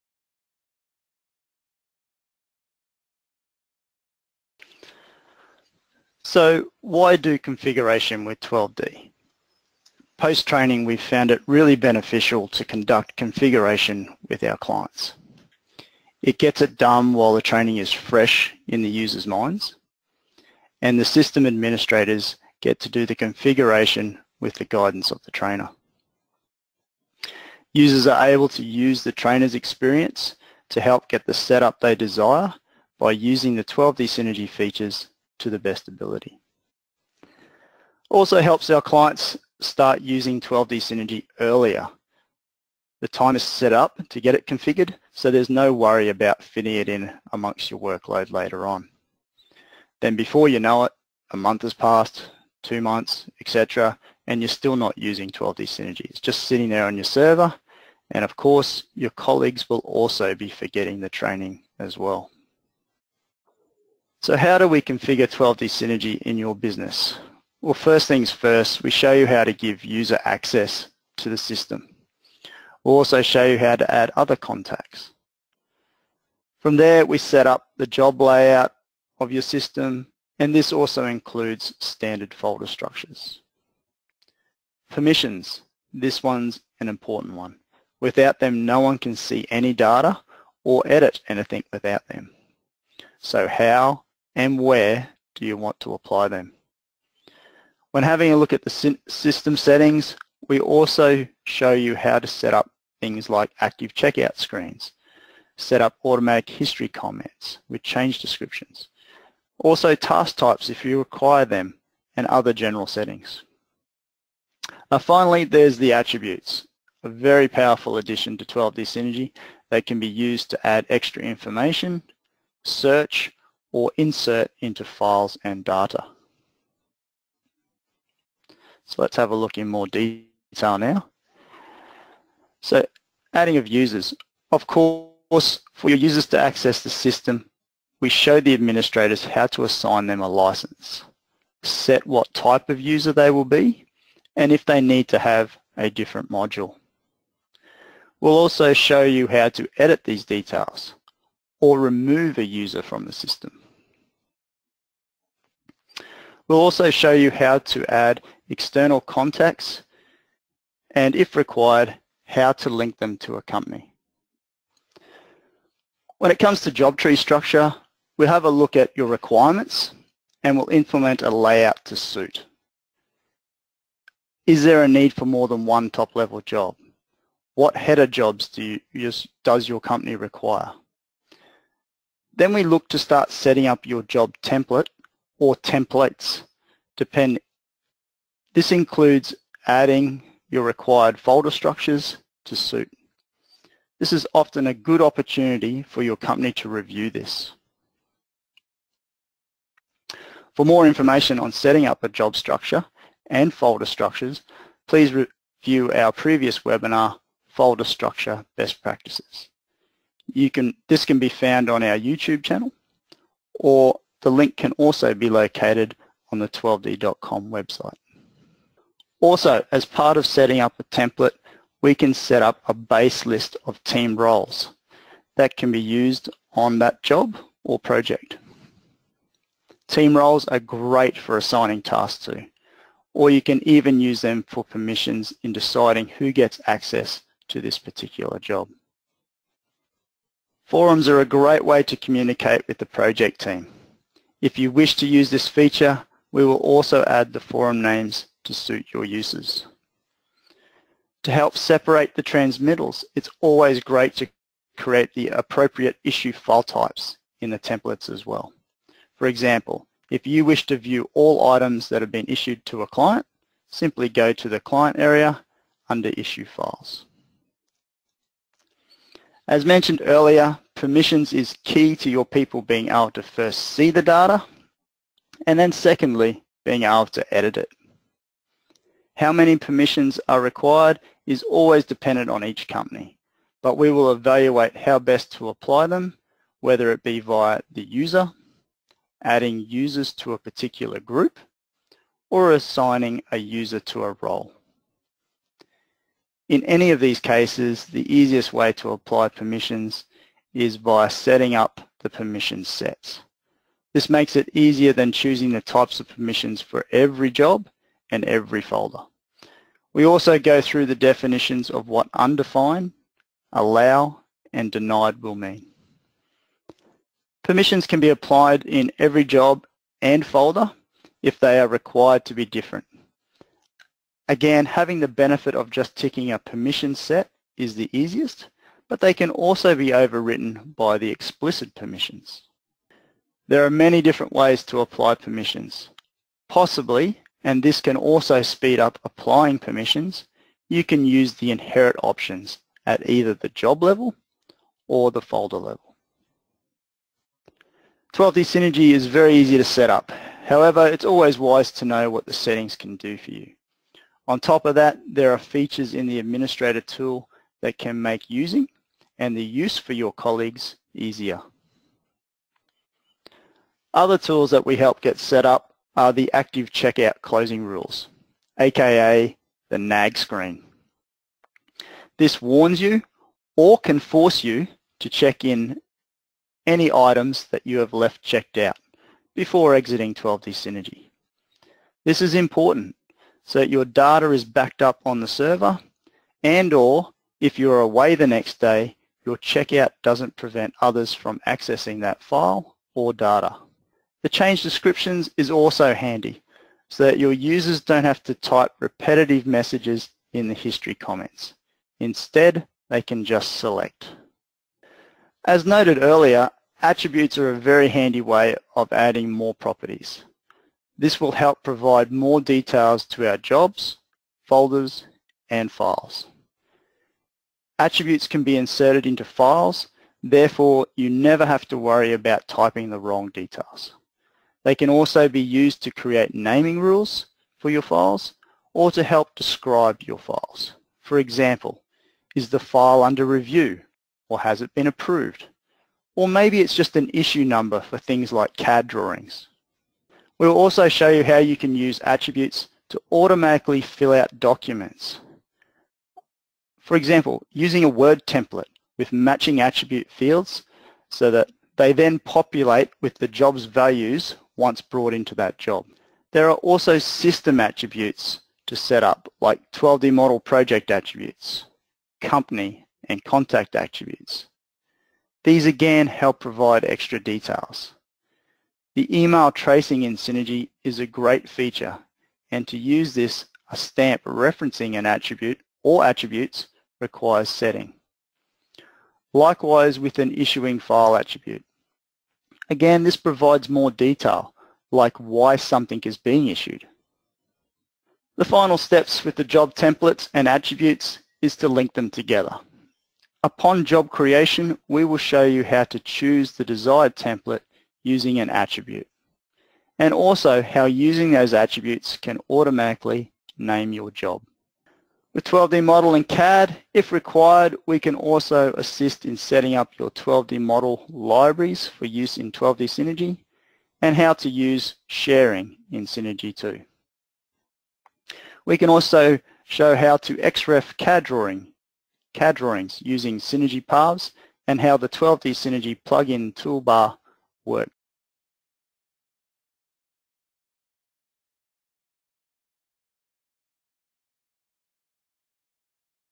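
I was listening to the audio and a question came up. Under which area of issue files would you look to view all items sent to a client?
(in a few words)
client area.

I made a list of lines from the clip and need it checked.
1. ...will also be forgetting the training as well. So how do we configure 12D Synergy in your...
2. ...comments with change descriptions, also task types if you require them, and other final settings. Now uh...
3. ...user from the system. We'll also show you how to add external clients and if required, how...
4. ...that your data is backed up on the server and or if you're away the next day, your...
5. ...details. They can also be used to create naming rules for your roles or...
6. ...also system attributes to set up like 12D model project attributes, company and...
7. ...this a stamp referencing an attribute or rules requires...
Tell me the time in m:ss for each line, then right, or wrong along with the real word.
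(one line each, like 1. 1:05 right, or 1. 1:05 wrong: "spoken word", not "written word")
1. 0:59 right
2. 1:46 wrong: "general", not "final"
3. 2:32 wrong: "contacts", not "clients"
4. 6:23 right
5. 7:03 wrong: "files", not "roles"
6. 7:36 right
7. 7:53 wrong: "attributes", not "rules".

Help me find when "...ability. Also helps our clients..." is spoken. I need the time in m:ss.
0:35.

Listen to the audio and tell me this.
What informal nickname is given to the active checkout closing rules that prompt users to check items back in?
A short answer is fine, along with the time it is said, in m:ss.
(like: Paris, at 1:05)
the nag screen, at 6:09.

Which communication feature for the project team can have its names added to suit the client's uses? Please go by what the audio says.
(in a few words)
Forums.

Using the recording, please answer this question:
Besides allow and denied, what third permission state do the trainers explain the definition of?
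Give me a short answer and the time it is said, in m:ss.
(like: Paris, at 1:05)
undefined, at 5:12.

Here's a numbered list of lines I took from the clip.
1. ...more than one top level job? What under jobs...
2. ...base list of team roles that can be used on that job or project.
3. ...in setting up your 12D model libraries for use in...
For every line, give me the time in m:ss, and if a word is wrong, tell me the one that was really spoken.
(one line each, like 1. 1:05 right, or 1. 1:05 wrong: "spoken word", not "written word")
1. 2:55 wrong: "header", not "under"
2. 3:42 right
3. 8:29 right.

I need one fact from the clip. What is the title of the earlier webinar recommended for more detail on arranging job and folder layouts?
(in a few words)
Folder Structure Best Practices.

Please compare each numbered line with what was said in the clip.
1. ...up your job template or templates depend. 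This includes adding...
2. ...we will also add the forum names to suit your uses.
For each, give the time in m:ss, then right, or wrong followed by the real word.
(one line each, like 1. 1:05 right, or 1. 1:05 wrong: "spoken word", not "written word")
1. 3:03 right
2. 4:06 right.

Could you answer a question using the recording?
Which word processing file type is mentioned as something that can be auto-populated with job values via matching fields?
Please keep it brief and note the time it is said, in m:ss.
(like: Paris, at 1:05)
Word template, at 7:28.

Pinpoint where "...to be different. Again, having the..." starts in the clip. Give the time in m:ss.
5:22.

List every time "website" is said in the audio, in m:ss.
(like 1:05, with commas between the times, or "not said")
3:37.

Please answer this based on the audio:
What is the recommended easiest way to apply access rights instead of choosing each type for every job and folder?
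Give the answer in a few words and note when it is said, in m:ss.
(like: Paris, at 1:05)
permission sets, at 5:02.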